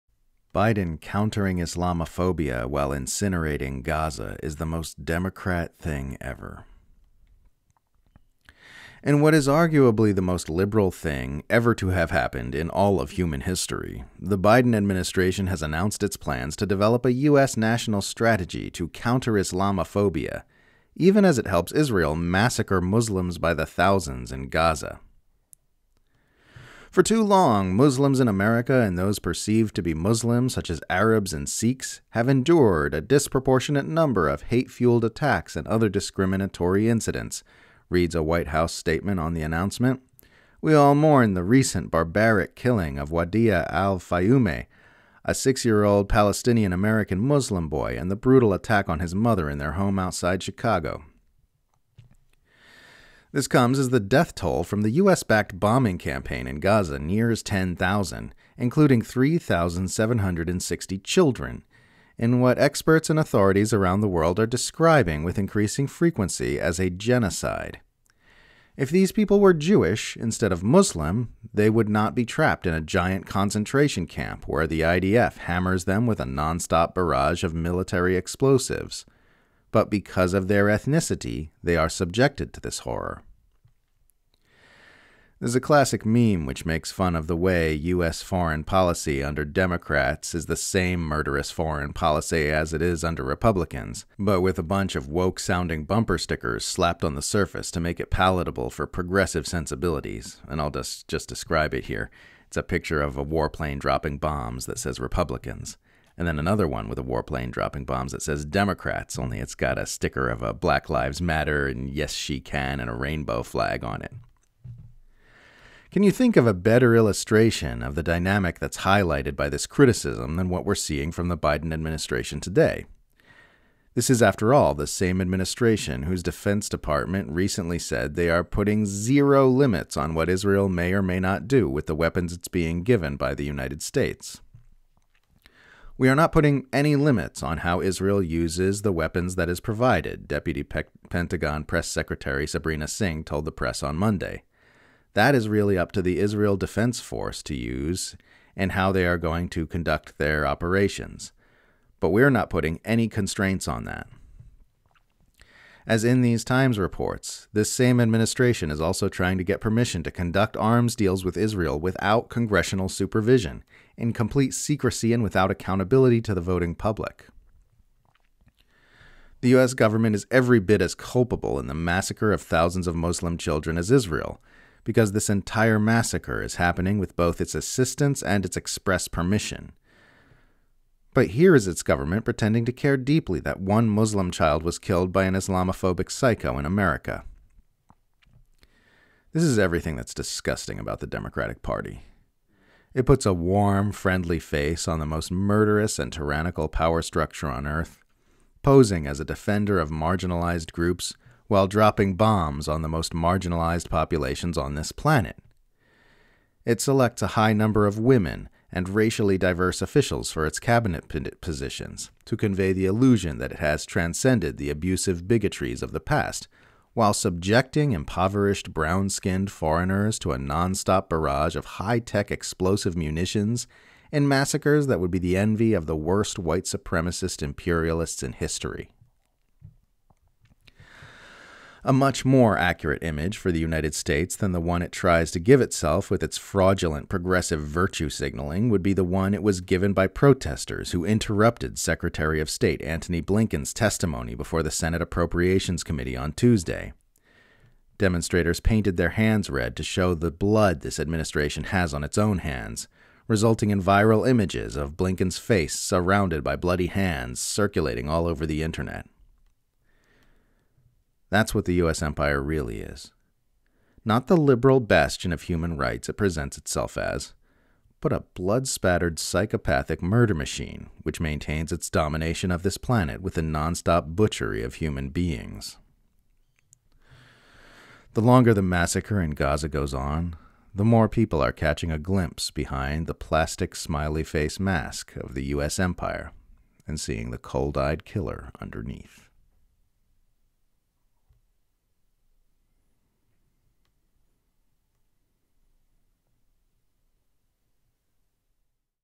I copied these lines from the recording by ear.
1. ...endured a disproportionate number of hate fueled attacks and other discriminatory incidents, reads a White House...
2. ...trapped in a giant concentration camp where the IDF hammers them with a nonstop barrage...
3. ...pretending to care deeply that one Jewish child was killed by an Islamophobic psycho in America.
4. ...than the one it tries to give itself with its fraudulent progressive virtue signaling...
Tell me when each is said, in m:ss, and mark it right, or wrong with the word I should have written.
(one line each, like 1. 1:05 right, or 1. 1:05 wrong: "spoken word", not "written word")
1. 0:32 right
2. 1:12 right
3. 3:02 wrong: "Muslim", not "Jewish"
4. 3:54 right.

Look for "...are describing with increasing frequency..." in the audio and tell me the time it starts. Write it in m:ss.
1:04.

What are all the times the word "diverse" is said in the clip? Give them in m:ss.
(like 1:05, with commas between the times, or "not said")
3:29.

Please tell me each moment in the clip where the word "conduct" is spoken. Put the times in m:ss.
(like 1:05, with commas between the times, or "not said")
2:29, 2:40.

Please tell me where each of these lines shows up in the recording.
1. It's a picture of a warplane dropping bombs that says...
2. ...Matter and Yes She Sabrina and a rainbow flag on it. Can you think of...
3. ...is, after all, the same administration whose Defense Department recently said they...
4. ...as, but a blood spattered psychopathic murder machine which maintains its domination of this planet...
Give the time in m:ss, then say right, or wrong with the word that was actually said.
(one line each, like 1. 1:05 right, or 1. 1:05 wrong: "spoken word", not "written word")
1. 1:42 right
2. 1:51 wrong: "Can", not "Sabrina"
3. 2:04 right
4. 4:26 right.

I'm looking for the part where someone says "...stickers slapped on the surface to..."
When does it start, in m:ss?
1:36.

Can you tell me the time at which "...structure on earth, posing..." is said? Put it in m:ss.
3:17.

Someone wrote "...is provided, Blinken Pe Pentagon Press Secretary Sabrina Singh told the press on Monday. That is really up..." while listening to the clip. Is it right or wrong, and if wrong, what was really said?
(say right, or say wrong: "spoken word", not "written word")
wrong: "Deputy", not "Blinken".